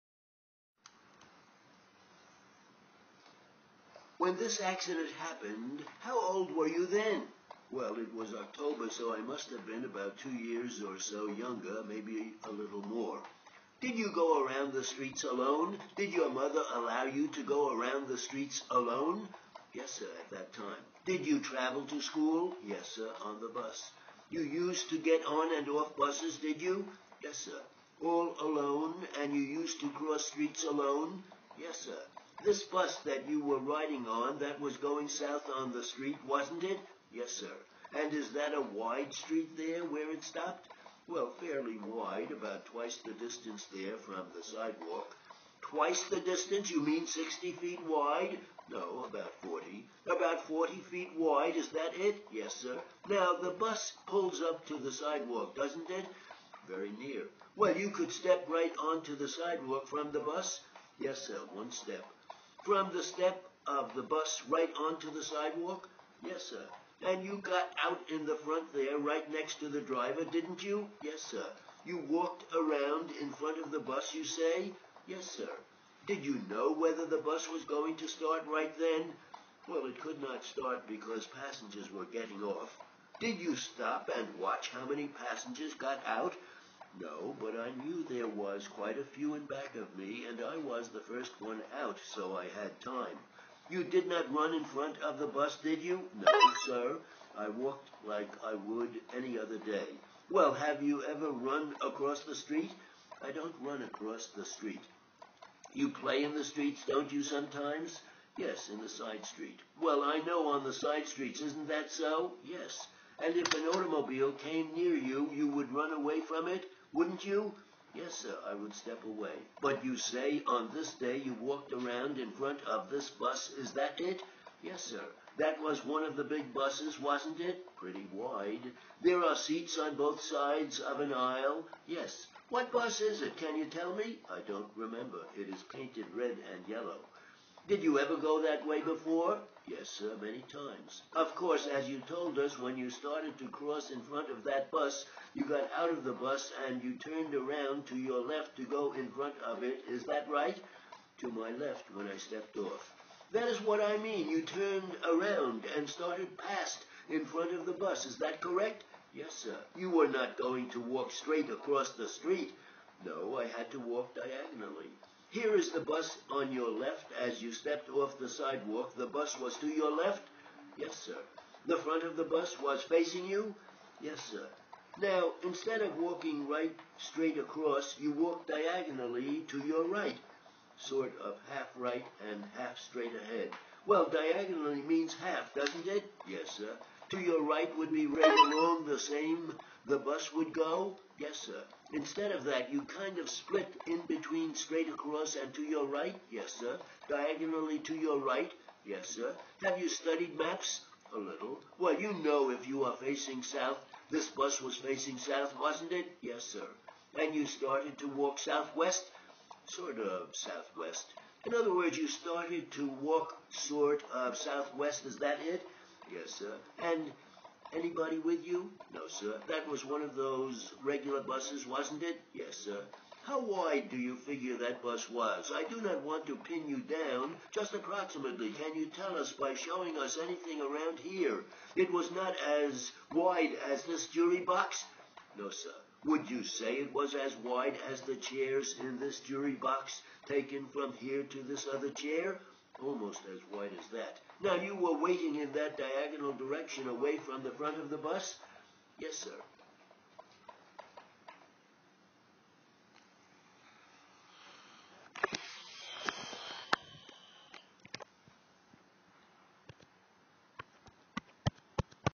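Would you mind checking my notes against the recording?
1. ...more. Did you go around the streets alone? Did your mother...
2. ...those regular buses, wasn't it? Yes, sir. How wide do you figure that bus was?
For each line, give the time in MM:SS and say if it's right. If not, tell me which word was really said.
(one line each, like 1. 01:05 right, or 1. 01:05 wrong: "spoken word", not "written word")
1. 00:12 right
2. 03:40 right.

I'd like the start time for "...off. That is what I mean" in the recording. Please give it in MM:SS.
02:32.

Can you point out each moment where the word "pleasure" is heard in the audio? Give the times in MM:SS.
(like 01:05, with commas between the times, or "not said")
not said.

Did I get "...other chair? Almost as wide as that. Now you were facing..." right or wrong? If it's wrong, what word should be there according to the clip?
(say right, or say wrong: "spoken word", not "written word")
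wrong: "waiting", not "facing".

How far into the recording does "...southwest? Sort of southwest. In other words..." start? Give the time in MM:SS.
03:28.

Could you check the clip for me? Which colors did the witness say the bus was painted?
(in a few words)
Red and yellow.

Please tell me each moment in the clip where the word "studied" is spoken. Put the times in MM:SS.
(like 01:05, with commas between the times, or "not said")
03:19.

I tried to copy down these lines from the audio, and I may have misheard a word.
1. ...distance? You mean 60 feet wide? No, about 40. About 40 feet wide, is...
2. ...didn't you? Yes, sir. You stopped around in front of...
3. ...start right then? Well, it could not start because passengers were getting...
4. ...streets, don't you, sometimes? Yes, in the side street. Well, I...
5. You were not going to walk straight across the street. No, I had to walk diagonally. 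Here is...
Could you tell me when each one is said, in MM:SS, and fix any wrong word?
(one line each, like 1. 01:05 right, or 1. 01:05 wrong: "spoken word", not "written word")
1. 00:46 right
2. 01:10 wrong: "walked", not "stopped"
3. 01:18 right
4. 01:46 right
5. 02:39 right.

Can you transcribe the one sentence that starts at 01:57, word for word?
Yes, sir, I would step away.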